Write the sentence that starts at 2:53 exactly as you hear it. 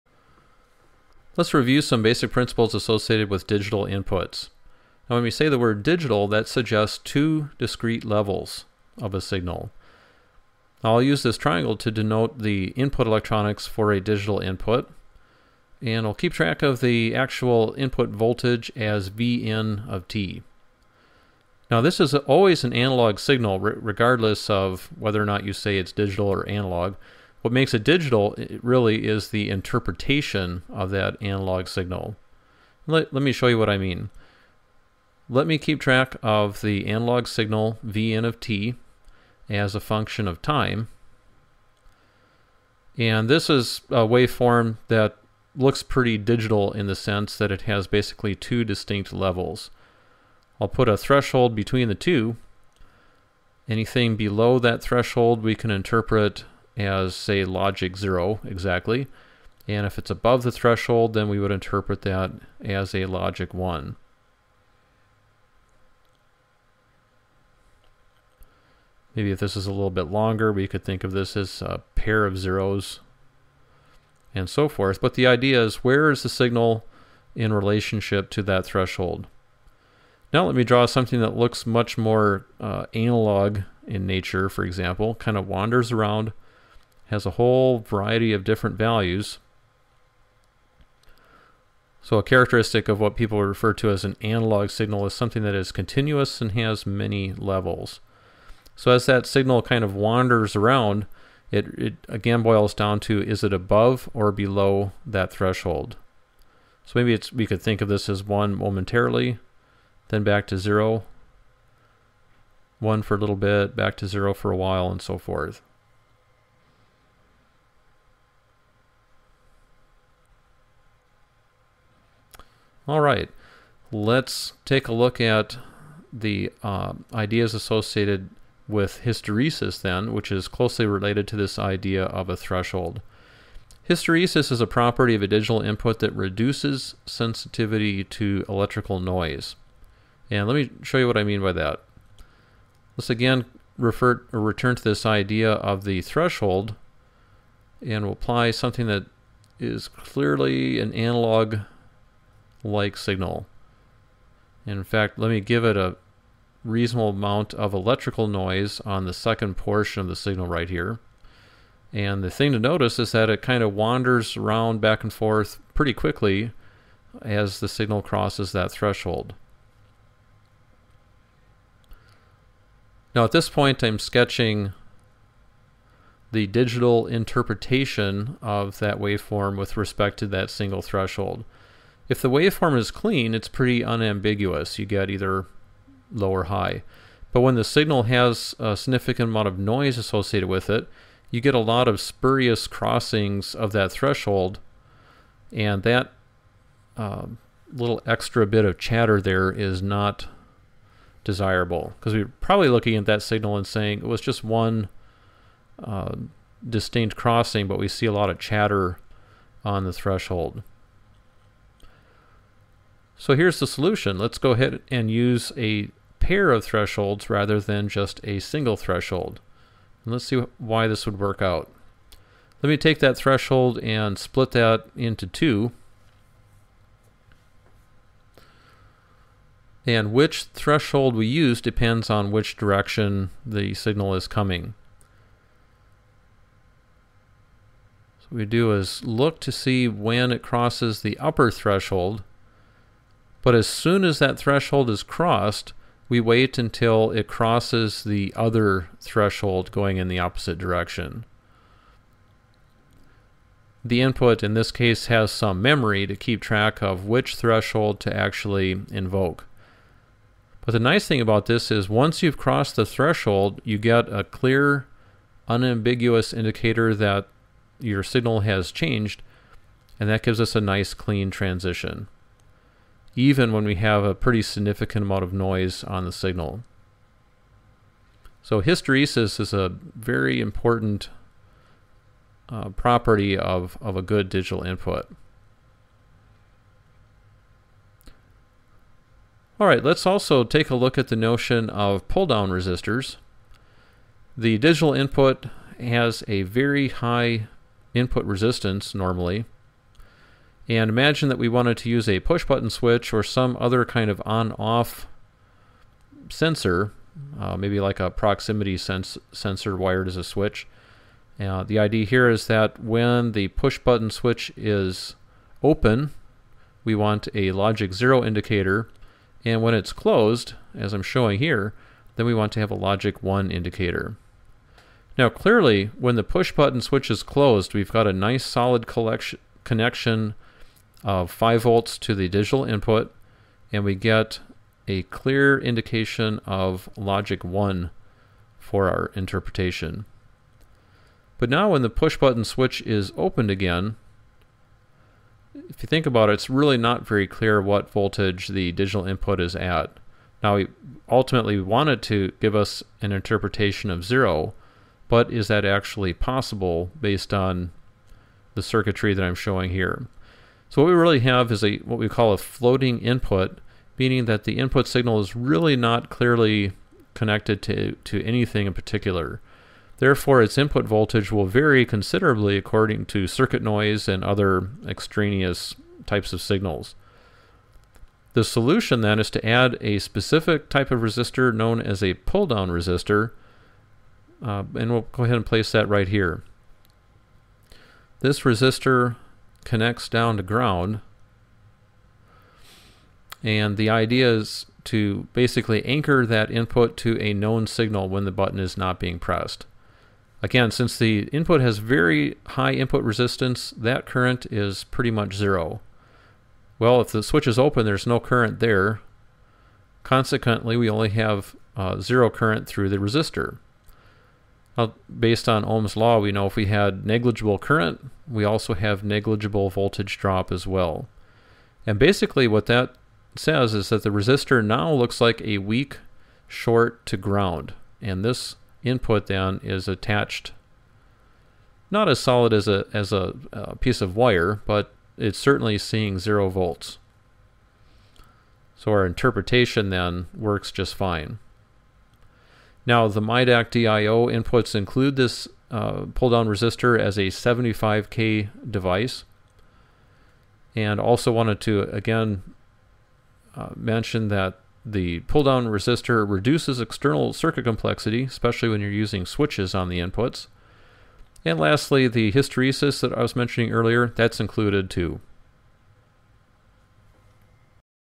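Now at this point I'm sketching the digital interpretation of that waveform with respect to that single threshold.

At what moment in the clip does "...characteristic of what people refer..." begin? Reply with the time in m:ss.
1:32.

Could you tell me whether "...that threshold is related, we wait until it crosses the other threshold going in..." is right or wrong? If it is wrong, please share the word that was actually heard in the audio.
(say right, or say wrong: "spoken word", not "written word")
wrong: "crossed", not "related".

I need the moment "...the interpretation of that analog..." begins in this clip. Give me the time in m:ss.
0:29.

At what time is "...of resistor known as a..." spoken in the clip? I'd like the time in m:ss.
6:20.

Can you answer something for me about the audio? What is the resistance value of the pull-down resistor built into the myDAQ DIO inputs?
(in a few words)
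75K.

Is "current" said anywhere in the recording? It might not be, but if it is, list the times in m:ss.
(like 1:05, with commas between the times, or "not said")
6:44, 6:48, 6:52, 6:57.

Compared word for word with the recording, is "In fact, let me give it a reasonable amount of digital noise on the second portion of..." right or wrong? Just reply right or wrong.
wrong.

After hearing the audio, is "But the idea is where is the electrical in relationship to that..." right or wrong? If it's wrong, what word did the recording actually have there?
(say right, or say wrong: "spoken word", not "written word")
wrong: "signal", not "electrical".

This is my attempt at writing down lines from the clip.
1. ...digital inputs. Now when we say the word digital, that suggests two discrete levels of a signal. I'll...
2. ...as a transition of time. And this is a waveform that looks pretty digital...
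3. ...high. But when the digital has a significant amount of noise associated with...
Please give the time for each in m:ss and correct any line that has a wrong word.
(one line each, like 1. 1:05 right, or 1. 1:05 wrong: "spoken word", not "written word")
1. 0:03 right
2. 0:39 wrong: "function", not "transition"
3. 3:06 wrong: "signal", not "digital".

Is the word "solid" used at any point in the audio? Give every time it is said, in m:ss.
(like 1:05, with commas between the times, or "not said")
5:28, 7:12.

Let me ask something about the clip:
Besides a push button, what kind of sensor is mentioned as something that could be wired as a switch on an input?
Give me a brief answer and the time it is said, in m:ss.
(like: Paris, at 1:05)
Proximity sensor, at 5:08.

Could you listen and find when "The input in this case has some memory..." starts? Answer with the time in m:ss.
4:13.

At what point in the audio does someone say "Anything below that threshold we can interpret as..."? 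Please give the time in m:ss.
0:53.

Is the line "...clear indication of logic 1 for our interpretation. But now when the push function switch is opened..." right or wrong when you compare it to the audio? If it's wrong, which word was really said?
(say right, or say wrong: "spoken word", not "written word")
wrong: "button", not "function".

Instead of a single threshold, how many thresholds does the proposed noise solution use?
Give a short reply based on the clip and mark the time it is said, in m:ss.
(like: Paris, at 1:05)
2, at 3:35.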